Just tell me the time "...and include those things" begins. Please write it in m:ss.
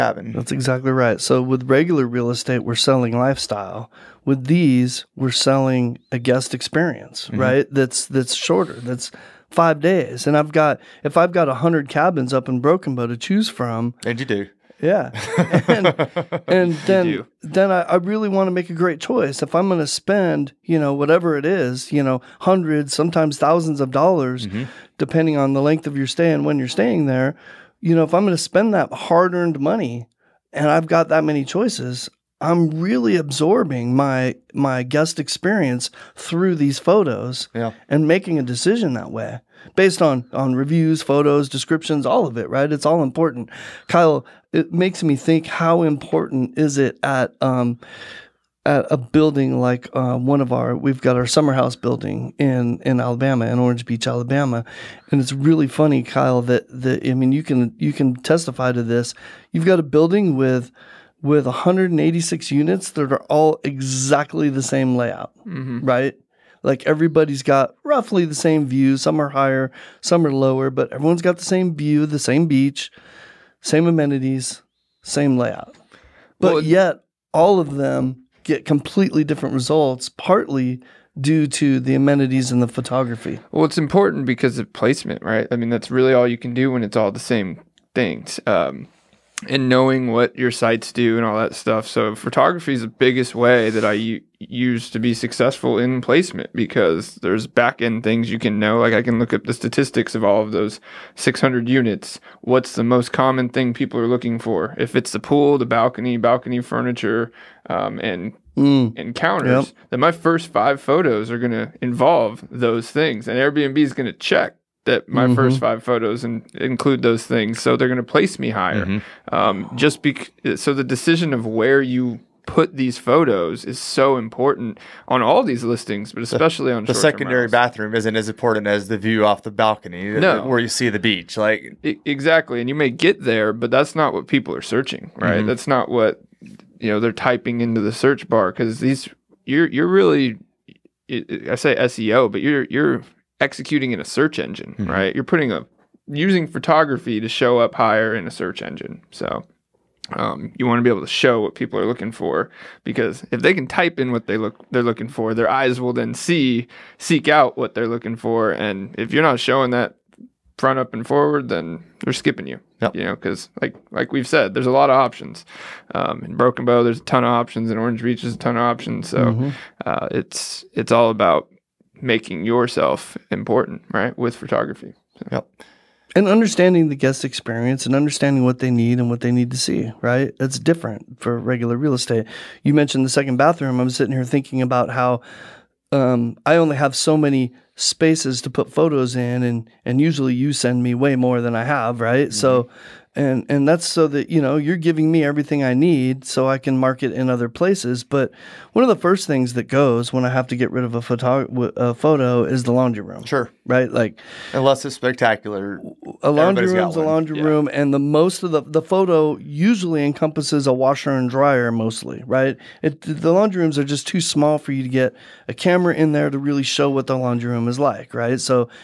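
1:56.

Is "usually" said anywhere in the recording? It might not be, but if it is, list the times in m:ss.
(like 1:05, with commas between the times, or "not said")
3:09, 3:29.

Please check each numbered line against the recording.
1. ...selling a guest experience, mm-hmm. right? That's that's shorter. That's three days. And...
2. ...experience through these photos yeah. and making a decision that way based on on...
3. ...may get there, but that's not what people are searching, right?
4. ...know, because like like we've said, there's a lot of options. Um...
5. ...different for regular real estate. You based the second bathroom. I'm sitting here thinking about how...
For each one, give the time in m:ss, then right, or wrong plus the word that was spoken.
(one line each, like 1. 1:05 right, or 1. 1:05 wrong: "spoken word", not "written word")
1. 0:05 wrong: "five", not "three"
2. 0:35 right
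3. 2:12 right
4. 2:43 right
5. 3:00 wrong: "mentioned", not "based".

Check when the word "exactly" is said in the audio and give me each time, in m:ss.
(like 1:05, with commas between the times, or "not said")
0:00, 1:03, 2:12.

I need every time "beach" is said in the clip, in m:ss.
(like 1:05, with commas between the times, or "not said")
0:53, 1:12, 2:10, 2:48.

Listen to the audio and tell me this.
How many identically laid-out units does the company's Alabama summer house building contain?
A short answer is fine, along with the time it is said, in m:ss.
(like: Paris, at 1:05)
186, at 1:01.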